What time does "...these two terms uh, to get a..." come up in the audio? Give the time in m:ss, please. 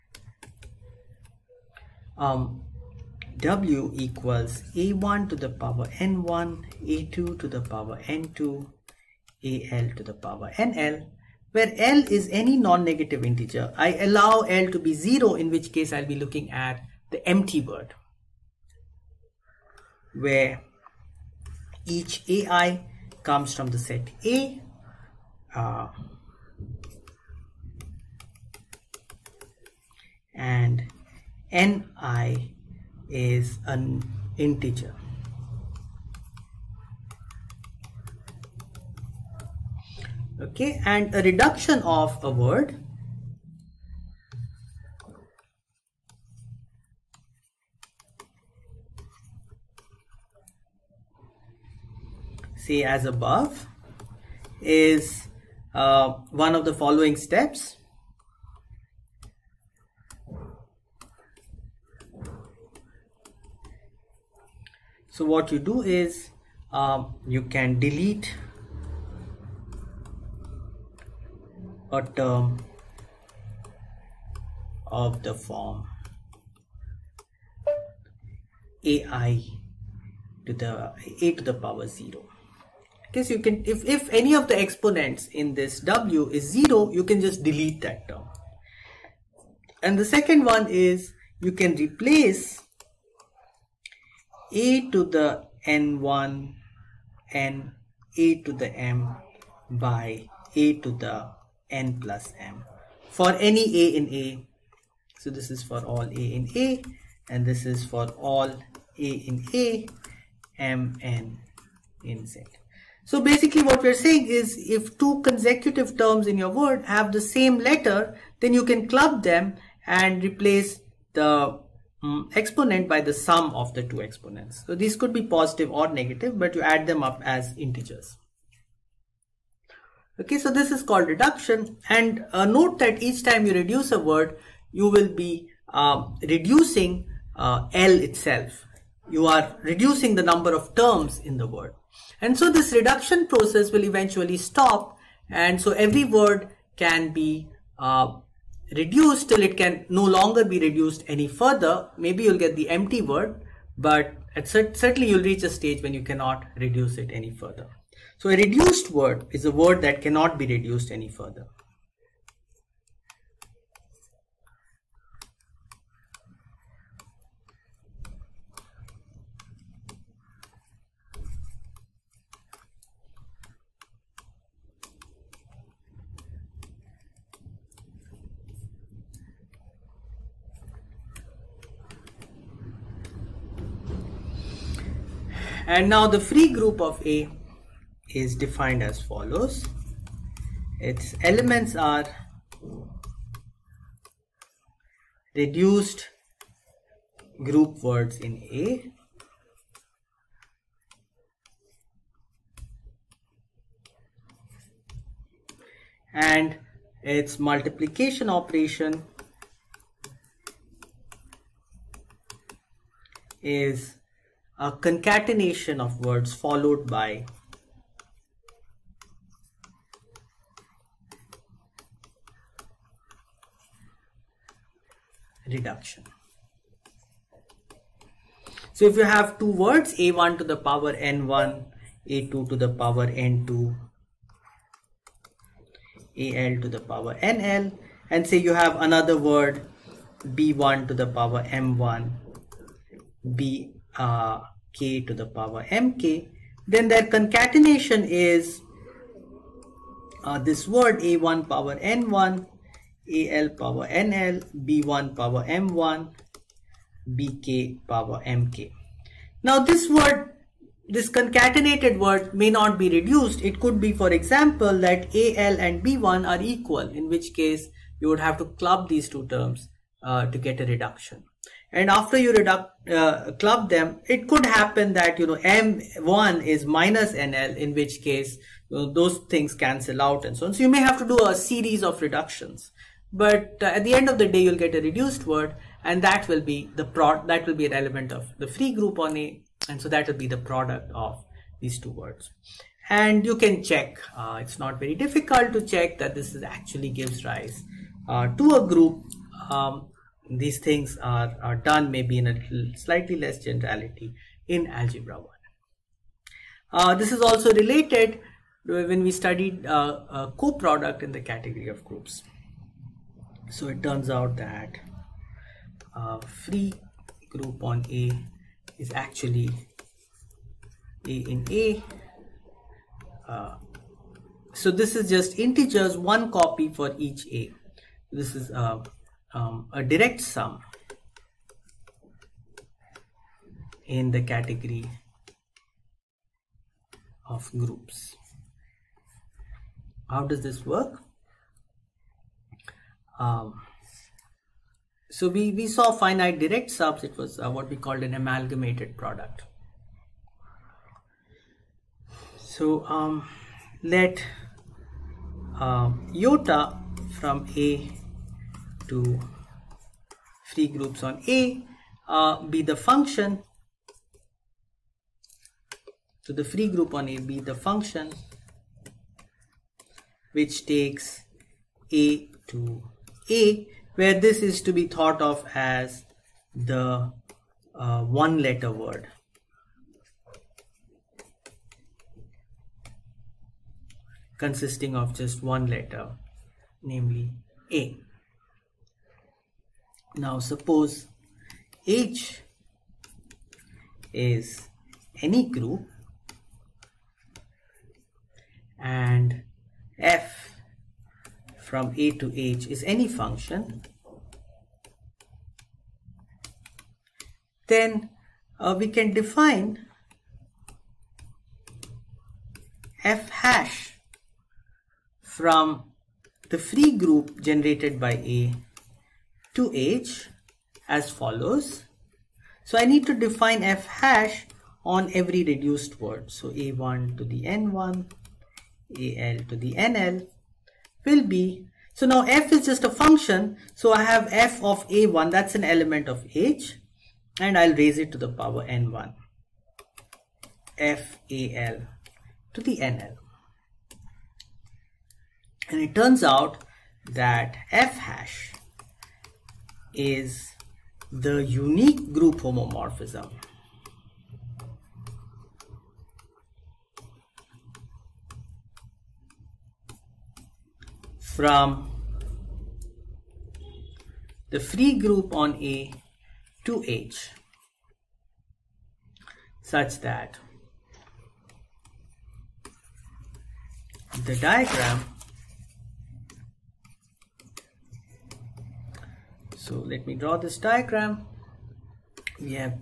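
4:28.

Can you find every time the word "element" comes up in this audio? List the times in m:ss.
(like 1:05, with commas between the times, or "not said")
3:11, 4:47, 7:15.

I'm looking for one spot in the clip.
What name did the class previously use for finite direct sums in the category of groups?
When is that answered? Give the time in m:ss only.
5:48.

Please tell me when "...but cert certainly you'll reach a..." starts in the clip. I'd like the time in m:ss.
2:33.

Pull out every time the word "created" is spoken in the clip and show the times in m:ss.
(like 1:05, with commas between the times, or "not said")
not said.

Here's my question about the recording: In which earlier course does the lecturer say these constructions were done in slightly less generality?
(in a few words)
Algebra 1.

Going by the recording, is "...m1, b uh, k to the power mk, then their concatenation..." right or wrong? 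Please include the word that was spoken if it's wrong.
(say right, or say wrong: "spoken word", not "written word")
right.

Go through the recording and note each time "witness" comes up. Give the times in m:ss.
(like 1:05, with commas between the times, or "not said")
not said.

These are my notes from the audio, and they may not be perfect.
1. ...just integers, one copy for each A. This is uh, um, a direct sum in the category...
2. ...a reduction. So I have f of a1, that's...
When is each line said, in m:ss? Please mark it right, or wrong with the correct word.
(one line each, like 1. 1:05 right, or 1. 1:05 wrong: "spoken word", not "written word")
1. 5:25 right
2. 7:12 wrong: "function", not "reduction".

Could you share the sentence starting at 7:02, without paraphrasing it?
So I need to define f hash on every reduced word.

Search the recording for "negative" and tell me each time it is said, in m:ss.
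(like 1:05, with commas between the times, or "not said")
0:12, 2:05.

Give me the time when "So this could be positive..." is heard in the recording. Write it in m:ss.
2:04.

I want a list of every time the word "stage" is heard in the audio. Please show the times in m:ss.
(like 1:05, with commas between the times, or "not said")
2:35.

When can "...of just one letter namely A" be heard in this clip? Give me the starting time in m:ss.
6:24.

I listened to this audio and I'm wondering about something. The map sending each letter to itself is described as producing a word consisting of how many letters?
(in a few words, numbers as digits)
1.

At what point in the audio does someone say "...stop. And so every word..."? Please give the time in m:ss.
2:24.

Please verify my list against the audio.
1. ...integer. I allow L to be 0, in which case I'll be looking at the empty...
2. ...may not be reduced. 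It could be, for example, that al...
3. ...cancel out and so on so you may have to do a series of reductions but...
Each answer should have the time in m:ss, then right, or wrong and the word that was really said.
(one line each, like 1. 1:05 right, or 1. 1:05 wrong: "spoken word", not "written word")
1. 0:13 right
2. 4:22 right
3. 4:39 right.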